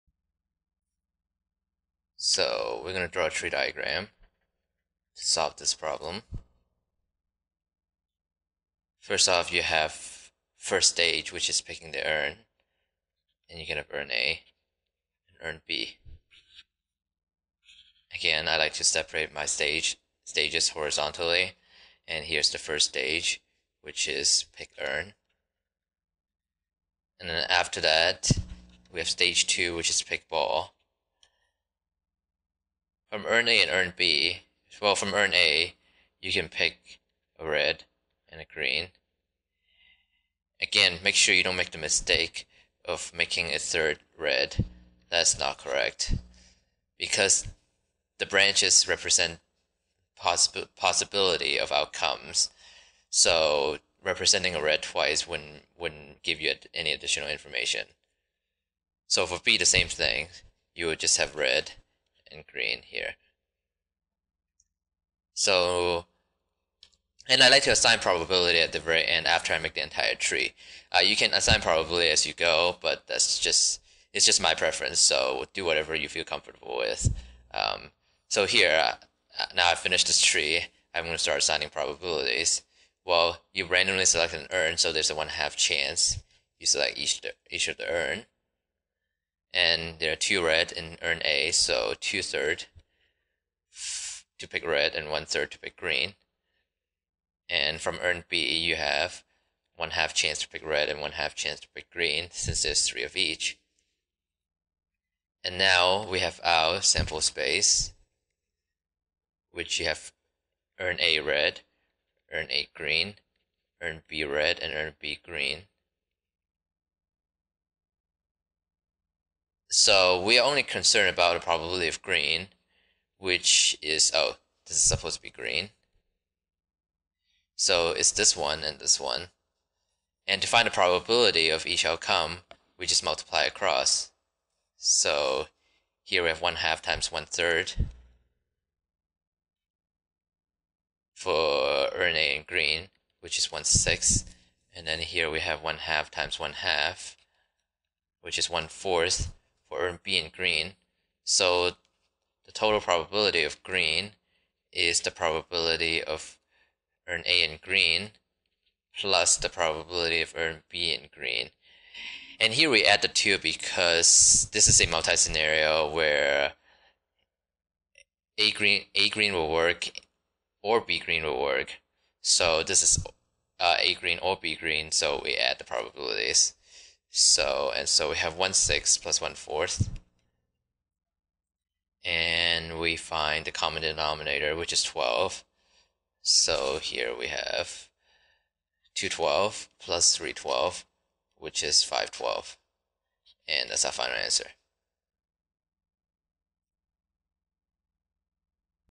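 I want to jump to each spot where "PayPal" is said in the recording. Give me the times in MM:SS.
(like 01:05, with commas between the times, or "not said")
not said.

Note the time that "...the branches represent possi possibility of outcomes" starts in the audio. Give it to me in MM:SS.
00:48.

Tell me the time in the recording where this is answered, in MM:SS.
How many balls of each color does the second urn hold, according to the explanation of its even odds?
01:42.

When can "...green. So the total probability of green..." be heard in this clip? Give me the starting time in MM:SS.
02:30.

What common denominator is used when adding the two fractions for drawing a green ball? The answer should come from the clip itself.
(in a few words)
12.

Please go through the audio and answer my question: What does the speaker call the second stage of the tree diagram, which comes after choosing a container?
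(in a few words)
pick ball.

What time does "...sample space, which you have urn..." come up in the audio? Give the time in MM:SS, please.
01:46.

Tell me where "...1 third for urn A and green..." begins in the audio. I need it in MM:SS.
02:17.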